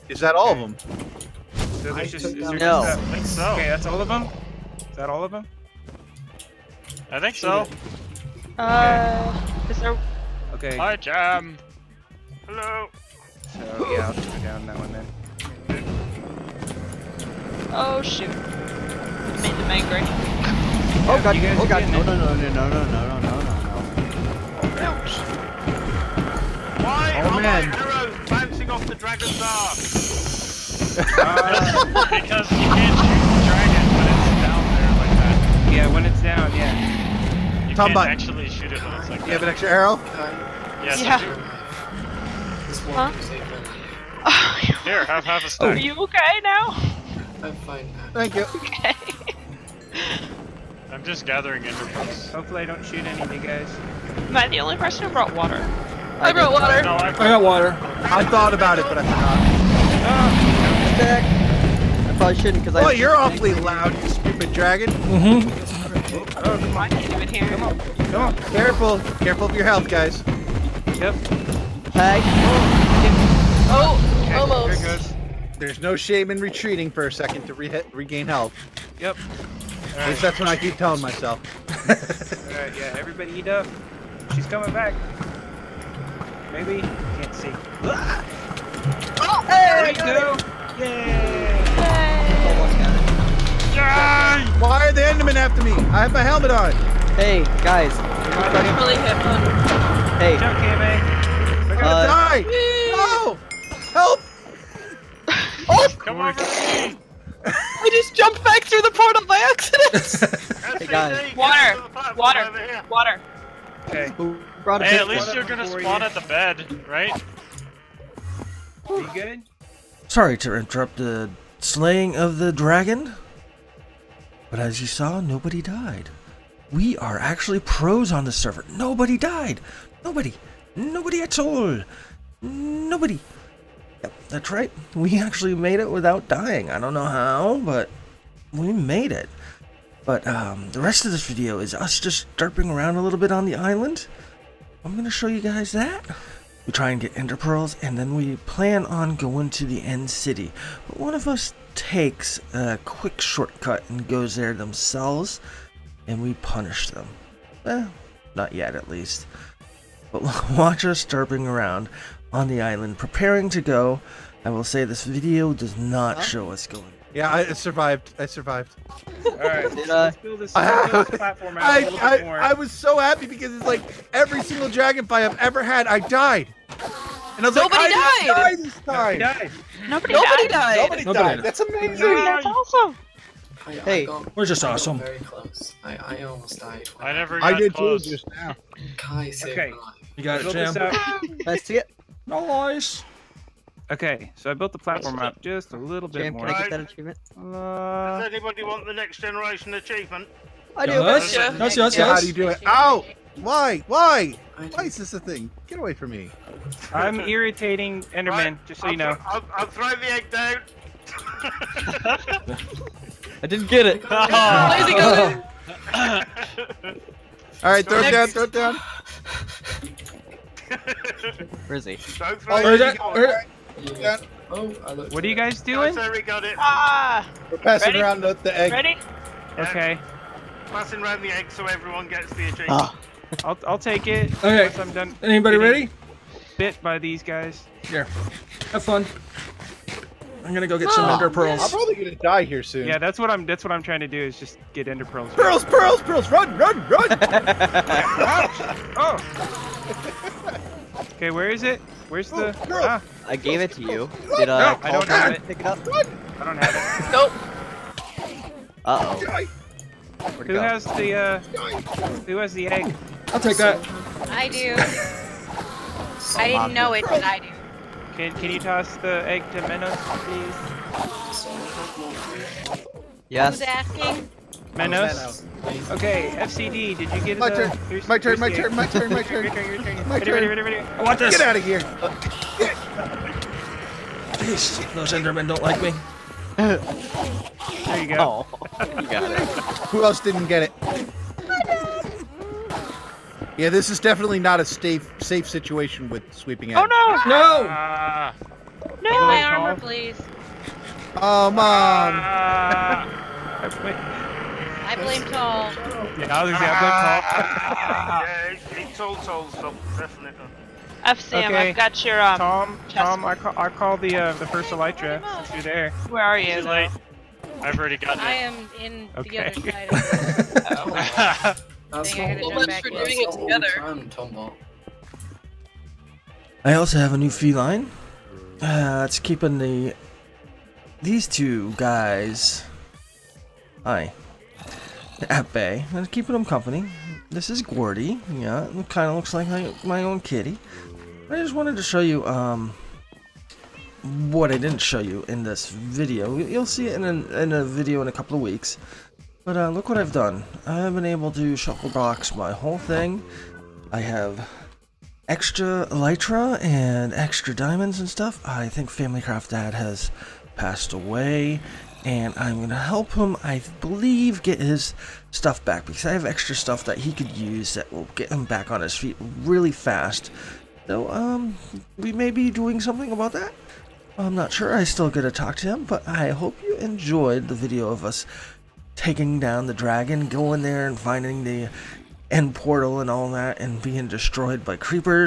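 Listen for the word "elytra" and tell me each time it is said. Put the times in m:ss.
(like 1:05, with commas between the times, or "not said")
5:14, 5:55.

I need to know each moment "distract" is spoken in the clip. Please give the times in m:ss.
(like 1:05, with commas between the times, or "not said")
not said.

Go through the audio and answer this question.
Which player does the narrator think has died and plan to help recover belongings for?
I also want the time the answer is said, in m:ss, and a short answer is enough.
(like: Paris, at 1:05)
Family Craft Dad, at 5:58.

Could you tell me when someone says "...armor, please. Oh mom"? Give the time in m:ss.
4:59.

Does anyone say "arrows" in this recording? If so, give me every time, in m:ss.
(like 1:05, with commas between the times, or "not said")
0:27, 0:39.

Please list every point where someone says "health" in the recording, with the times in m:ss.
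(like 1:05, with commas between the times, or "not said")
1:09, 1:18.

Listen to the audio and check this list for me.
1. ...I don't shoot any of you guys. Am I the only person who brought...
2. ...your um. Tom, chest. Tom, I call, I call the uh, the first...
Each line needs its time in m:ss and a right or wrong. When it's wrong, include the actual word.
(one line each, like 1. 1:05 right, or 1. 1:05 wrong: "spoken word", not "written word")
1. 0:52 right
2. 5:12 right.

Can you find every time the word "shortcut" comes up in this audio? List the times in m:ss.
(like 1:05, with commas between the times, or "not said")
2:33.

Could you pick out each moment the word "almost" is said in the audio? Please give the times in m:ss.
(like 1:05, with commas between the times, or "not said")
1:14, 3:06.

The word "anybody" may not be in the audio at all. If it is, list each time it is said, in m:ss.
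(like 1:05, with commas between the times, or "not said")
3:18, 3:55.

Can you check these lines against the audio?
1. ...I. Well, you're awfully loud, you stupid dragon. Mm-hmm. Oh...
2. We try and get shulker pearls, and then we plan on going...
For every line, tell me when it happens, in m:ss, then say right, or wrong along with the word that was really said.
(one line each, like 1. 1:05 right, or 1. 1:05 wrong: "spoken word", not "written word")
1. 1:02 right
2. 2:26 wrong: "ender", not "shulker".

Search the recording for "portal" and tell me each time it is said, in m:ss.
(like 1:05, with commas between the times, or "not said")
1:48, 6:22.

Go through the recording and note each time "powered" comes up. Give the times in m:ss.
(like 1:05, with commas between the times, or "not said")
not said.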